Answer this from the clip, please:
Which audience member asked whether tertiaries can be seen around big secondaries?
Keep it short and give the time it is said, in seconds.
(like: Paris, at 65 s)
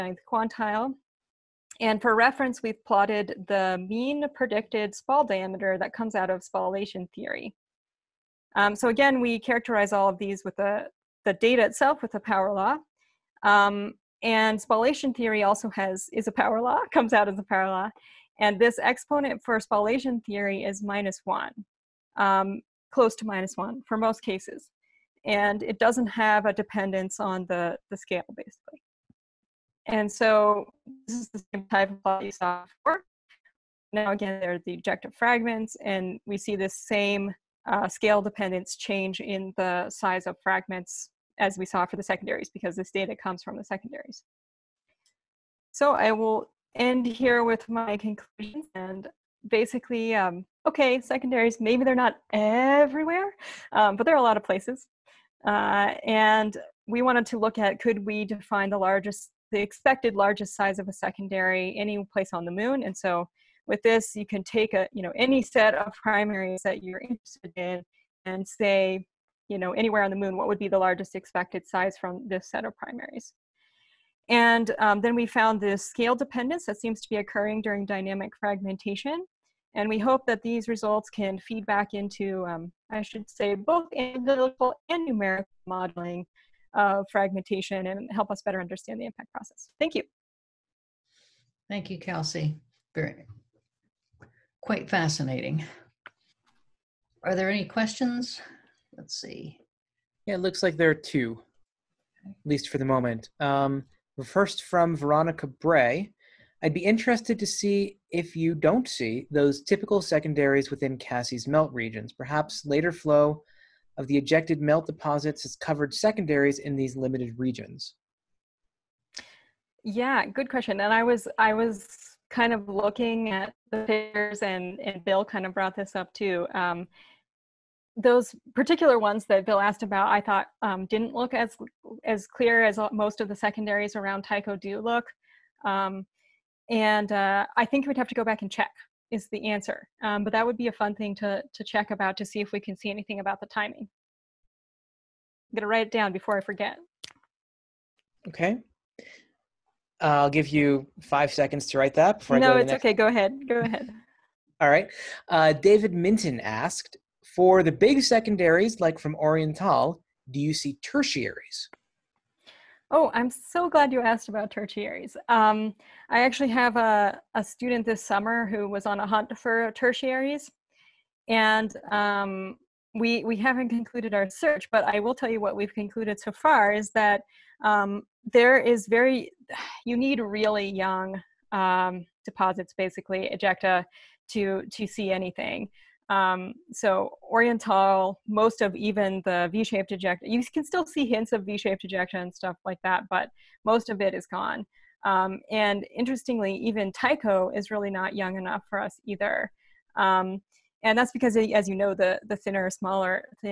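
David Minton, at 155 s.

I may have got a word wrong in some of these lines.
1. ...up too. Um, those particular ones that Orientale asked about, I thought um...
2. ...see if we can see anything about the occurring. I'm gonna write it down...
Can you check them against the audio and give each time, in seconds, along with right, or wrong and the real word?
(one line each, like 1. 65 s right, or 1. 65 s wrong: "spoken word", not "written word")
1. 125 s wrong: "Bill", not "Orientale"
2. 142 s wrong: "timing", not "occurring".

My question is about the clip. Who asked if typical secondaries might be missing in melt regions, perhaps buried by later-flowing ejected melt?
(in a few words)
Veronica Bray.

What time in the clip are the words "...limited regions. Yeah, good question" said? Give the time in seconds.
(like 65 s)
116 s.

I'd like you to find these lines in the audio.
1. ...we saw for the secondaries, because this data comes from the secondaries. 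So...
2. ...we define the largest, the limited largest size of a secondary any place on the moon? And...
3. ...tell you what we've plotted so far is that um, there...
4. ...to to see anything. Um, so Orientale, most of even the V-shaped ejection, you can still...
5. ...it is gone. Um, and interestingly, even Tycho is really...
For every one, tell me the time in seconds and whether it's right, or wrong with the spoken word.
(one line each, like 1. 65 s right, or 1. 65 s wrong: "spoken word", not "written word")
1. 41 s right
2. 58 s wrong: "expected", not "limited"
3. 175 s wrong: "concluded", not "plotted"
4. 184 s right
5. 194 s right.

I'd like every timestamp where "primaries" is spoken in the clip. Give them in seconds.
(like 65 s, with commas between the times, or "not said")
65 s, 72 s.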